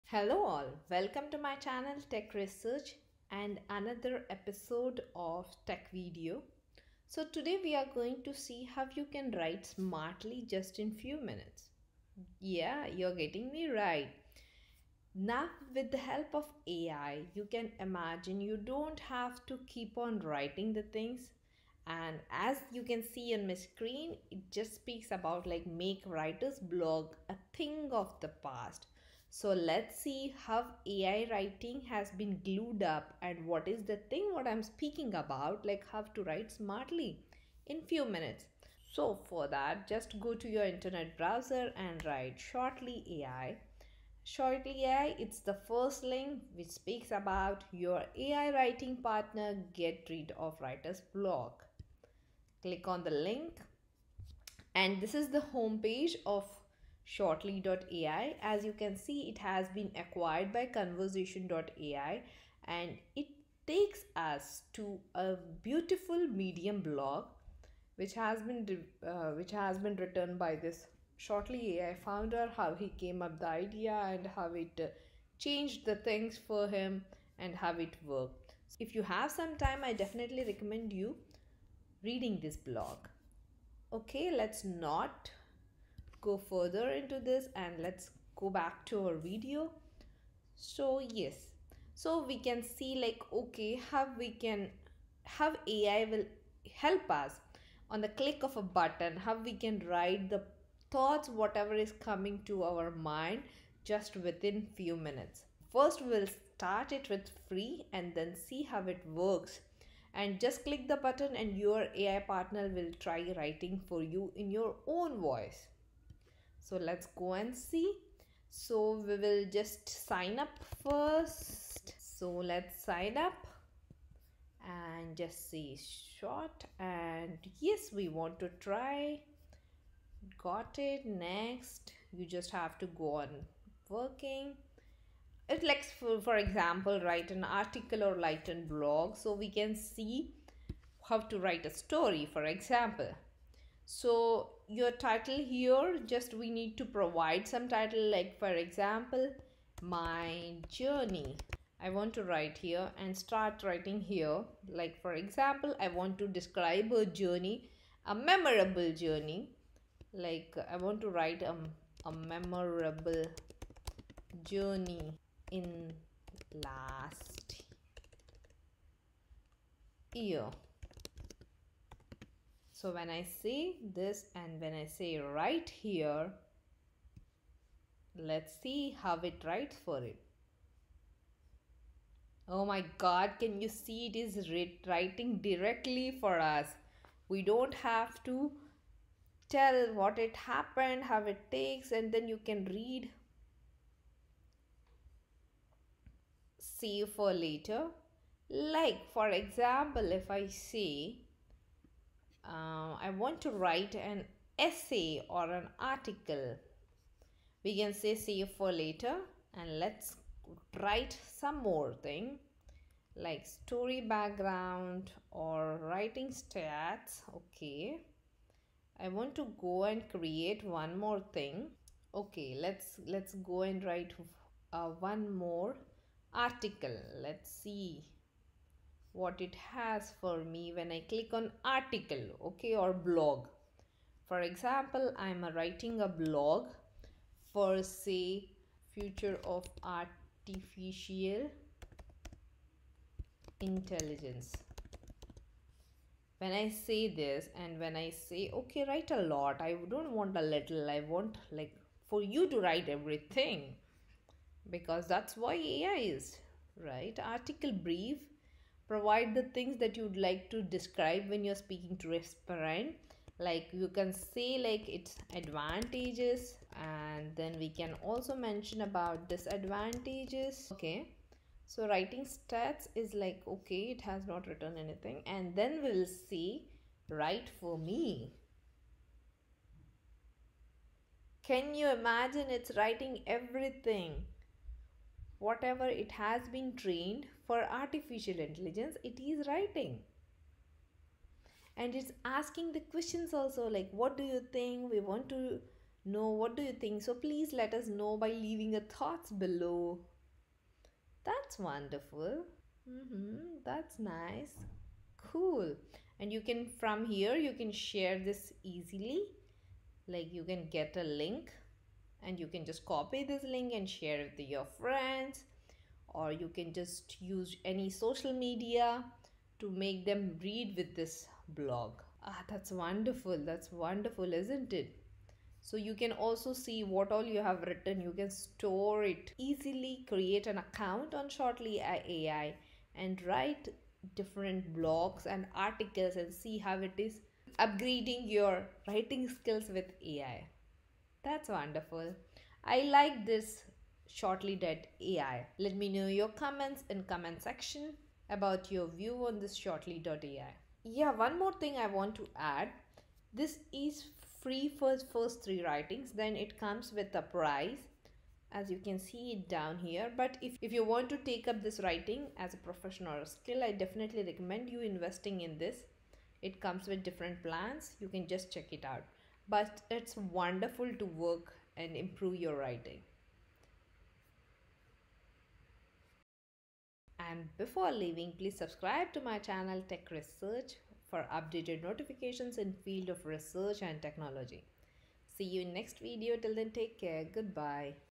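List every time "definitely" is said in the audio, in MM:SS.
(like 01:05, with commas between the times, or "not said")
01:20, 06:03.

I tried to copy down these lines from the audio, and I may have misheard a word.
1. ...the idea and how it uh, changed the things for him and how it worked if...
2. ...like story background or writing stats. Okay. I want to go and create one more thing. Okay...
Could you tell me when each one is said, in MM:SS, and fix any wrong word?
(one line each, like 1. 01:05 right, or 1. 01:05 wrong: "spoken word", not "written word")
1. 01:13 right
2. 03:33 right.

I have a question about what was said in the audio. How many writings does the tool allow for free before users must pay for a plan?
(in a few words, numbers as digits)
3.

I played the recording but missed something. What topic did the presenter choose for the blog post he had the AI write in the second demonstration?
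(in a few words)
Future of artificial intelligence.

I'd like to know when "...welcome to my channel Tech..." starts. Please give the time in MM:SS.
00:00.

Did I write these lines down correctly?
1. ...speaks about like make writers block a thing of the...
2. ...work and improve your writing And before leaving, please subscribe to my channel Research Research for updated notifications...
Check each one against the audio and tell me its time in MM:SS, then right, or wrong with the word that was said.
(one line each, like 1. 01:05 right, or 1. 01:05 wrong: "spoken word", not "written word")
1. 00:24 right
2. 06:11 wrong: "Tech", not "Research".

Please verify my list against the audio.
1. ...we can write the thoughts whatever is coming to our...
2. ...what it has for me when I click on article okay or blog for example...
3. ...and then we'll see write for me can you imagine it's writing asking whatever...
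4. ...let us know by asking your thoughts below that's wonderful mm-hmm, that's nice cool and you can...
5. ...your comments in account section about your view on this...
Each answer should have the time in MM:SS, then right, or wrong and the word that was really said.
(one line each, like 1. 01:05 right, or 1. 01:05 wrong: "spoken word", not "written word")
1. 01:39 right
2. 03:49 right
3. 04:35 wrong: "everything", not "asking"
4. 04:57 wrong: "leaving", not "asking"
5. 05:46 wrong: "comment", not "account".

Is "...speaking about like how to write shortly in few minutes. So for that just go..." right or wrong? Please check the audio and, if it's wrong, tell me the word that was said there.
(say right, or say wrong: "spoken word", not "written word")
wrong: "smartly", not "shortly".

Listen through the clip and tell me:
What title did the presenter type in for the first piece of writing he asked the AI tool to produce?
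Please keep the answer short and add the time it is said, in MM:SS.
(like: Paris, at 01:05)
My journey, at 02:29.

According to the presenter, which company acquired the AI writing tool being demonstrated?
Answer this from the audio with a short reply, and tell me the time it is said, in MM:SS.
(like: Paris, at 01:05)
conversion.ai, at 01:00.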